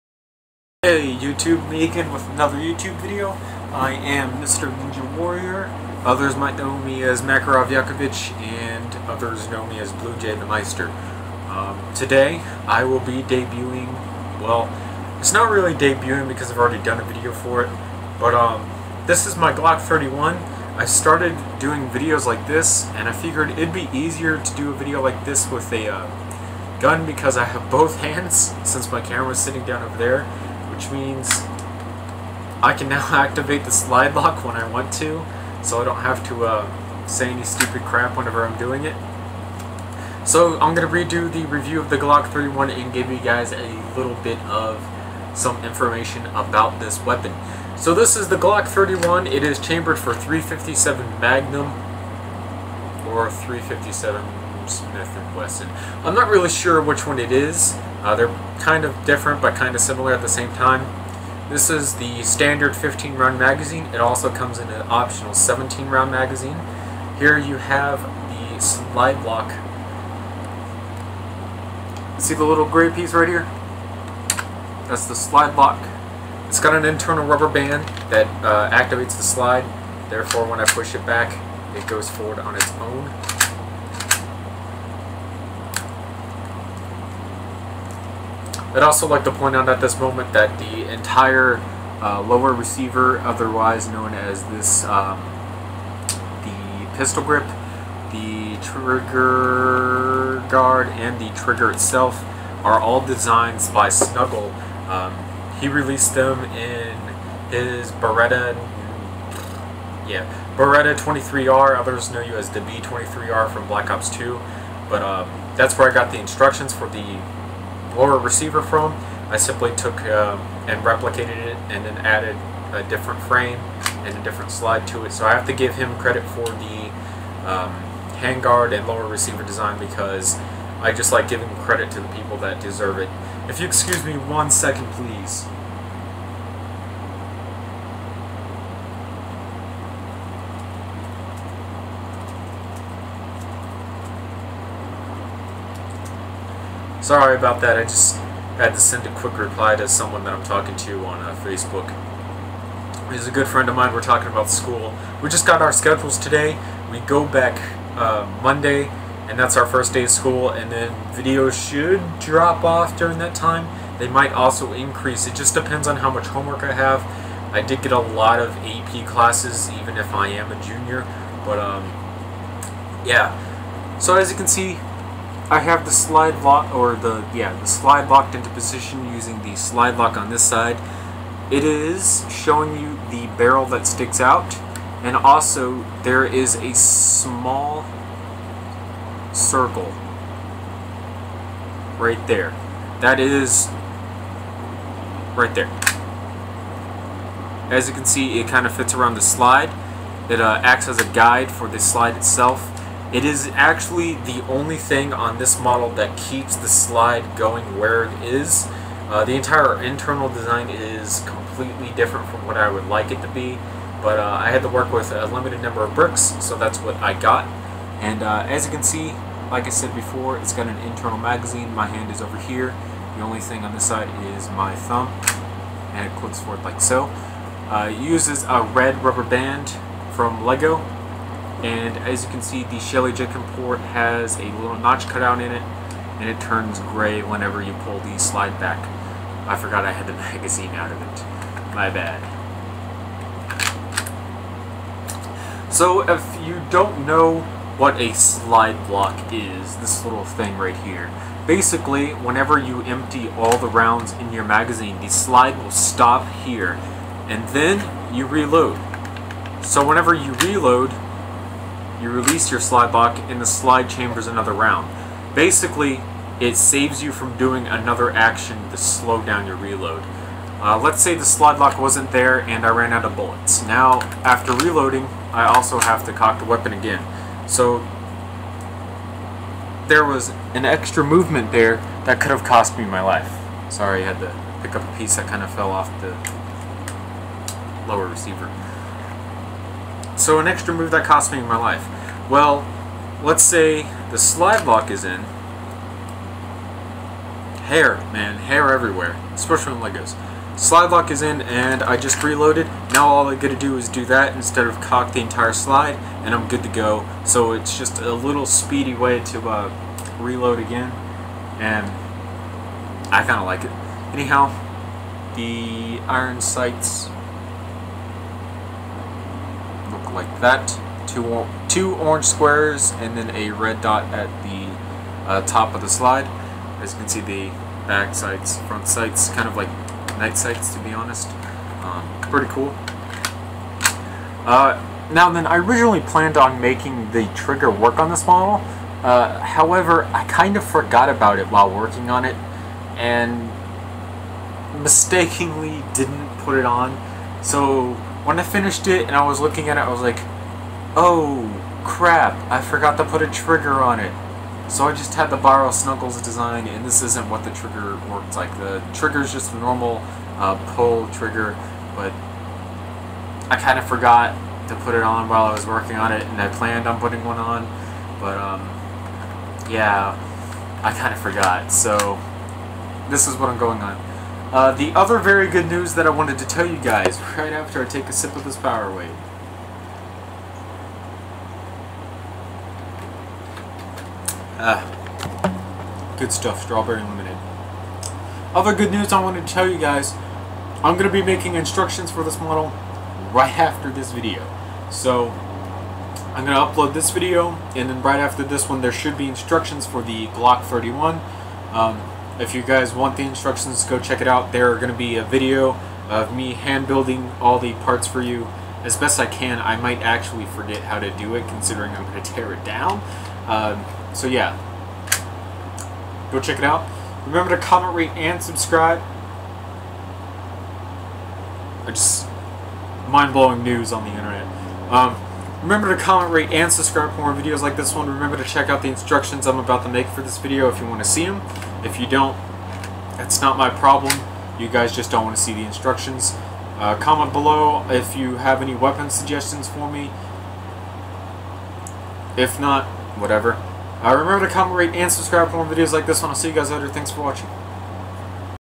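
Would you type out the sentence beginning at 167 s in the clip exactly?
I did get a lot of AP classes, even if I am a junior, but um, yeah.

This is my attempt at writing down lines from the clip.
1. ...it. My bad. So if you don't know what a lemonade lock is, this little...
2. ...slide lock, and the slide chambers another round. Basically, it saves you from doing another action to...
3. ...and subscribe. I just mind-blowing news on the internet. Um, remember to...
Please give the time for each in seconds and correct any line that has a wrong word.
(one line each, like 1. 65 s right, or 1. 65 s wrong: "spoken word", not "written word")
1. 241 s wrong: "slide", not "lemonade"
2. 262 s right
3. 418 s right.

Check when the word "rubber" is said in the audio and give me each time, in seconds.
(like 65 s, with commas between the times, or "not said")
77 s, 229 s.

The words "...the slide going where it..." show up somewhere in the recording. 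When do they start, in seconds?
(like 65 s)
206 s.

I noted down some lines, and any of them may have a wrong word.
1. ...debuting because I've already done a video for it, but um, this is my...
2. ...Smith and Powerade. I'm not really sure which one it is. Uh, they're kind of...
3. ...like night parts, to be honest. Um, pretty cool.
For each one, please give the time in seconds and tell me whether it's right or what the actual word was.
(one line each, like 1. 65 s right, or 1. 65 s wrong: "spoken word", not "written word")
1. 15 s right
2. 54 s wrong: "Wesson", not "Powerade"
3. 329 s wrong: "sights", not "parts".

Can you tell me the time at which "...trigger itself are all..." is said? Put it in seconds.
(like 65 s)
101 s.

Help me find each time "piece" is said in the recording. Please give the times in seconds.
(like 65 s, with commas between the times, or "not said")
72 s, 284 s.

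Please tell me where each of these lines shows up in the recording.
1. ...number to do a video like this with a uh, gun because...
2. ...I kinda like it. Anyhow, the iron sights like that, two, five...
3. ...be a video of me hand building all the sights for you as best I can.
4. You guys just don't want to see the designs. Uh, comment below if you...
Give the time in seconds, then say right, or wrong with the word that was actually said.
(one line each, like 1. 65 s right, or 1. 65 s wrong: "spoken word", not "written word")
1. 23 s wrong: "easier", not "number"
2. 313 s wrong: "two", not "five"
3. 404 s wrong: "parts", not "sights"
4. 434 s wrong: "instructions", not "designs".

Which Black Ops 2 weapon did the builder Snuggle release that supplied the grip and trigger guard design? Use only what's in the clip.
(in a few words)
Beretta 23R.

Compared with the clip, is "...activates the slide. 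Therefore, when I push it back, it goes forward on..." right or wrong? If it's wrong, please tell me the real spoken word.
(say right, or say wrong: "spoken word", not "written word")
right.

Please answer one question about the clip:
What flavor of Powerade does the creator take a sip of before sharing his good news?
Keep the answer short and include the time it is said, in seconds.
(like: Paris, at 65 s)
Strawberry lemonade, at 386 s.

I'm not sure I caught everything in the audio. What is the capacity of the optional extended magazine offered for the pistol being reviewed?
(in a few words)
17 rounds.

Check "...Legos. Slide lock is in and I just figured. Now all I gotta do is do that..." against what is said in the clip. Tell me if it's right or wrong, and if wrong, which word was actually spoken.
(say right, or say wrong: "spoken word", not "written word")
wrong: "reloaded", not "figured".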